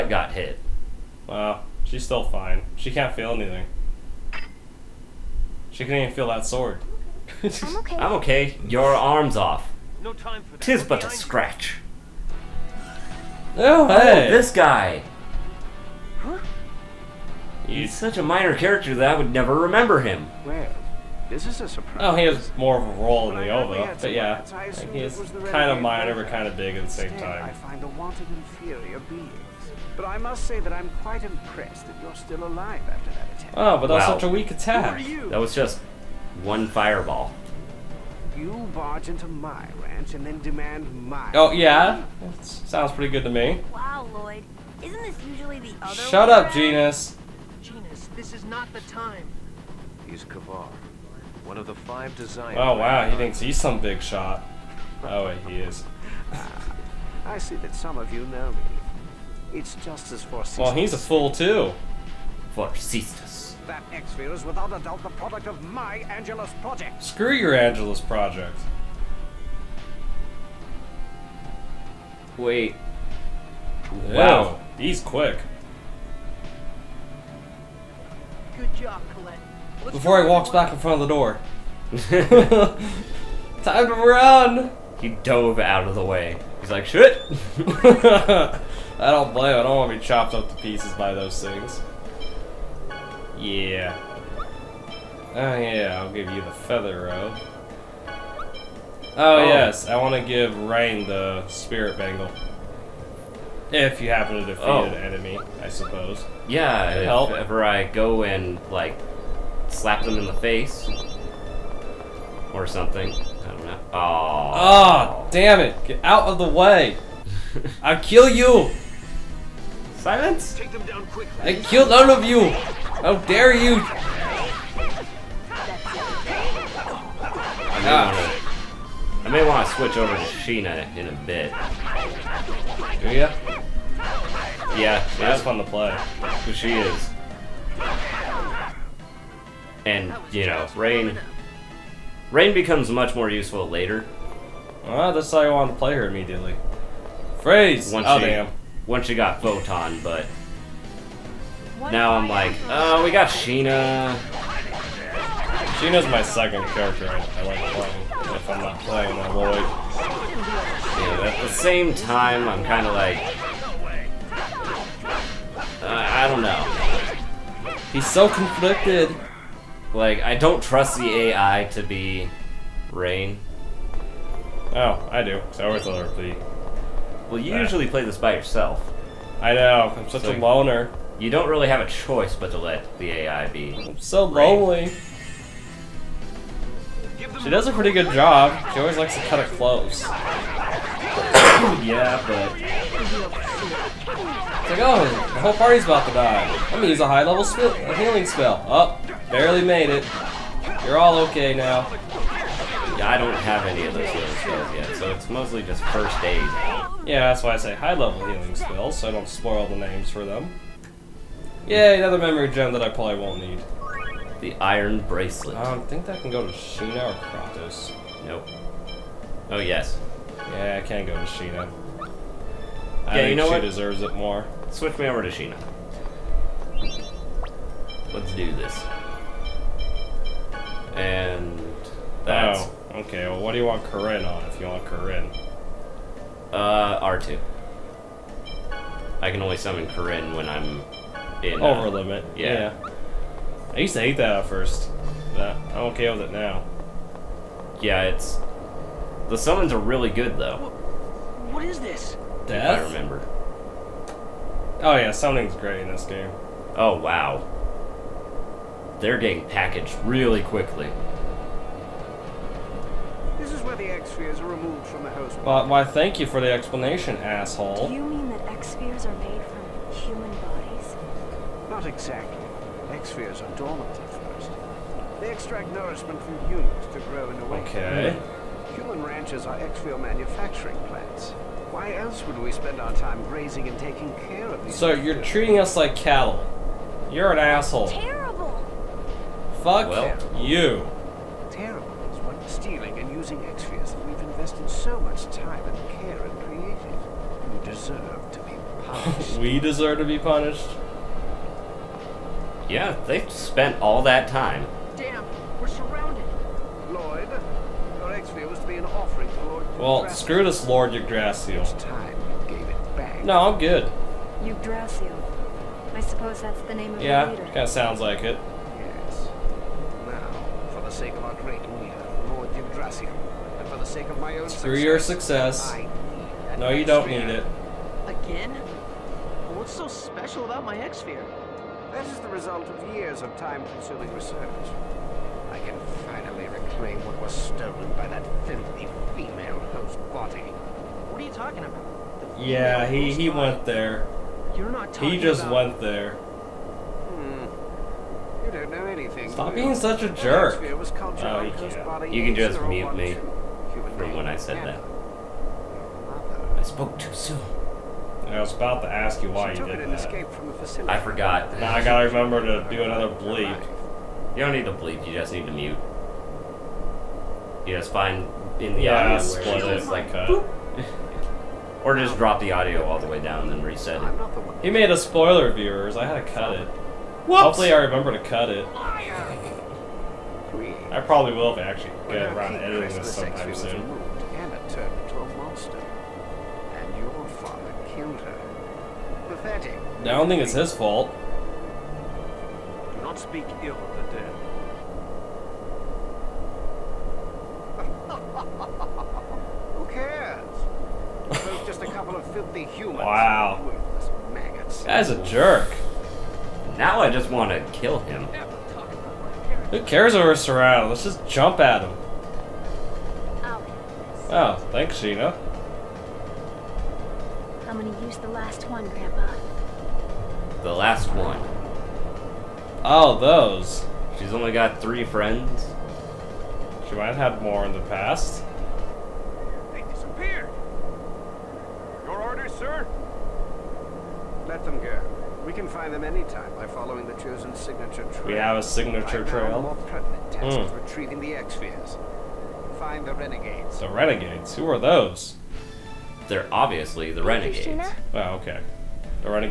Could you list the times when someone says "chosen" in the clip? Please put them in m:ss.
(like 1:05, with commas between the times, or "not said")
7:17.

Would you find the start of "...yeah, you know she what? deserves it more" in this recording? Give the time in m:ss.
3:43.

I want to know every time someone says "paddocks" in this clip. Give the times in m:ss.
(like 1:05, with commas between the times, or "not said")
not said.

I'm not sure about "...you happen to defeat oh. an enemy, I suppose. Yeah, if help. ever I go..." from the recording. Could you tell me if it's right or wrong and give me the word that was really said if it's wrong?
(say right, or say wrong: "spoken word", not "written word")
right.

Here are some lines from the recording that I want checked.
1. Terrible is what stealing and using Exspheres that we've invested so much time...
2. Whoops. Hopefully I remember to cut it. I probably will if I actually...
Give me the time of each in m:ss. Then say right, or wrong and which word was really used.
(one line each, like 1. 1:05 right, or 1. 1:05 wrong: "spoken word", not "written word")
1. 4:51 right
2. 6:17 right.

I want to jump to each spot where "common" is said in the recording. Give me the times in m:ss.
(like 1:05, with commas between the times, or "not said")
not said.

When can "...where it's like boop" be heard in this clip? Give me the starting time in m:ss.
6:09.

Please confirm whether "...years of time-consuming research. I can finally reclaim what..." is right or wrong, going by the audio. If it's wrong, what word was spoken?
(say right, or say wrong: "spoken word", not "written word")
right.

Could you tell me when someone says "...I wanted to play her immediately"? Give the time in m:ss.
2:25.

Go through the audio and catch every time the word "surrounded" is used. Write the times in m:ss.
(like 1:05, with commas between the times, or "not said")
5:05, 6:50.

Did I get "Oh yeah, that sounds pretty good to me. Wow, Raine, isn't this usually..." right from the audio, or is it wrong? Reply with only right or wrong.
wrong.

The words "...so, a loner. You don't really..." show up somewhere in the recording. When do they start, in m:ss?
3:00.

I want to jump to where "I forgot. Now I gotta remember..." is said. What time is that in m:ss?
6:00.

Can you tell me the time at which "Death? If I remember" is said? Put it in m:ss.
4:12.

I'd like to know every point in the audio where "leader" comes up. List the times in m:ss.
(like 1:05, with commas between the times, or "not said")
5:17, 5:21.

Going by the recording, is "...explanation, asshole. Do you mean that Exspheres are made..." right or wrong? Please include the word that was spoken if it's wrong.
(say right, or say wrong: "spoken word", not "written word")
right.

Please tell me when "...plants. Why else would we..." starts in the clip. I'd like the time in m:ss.
4:40.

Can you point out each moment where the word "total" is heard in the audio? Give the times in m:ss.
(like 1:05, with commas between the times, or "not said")
not said.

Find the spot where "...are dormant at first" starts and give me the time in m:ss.
4:33.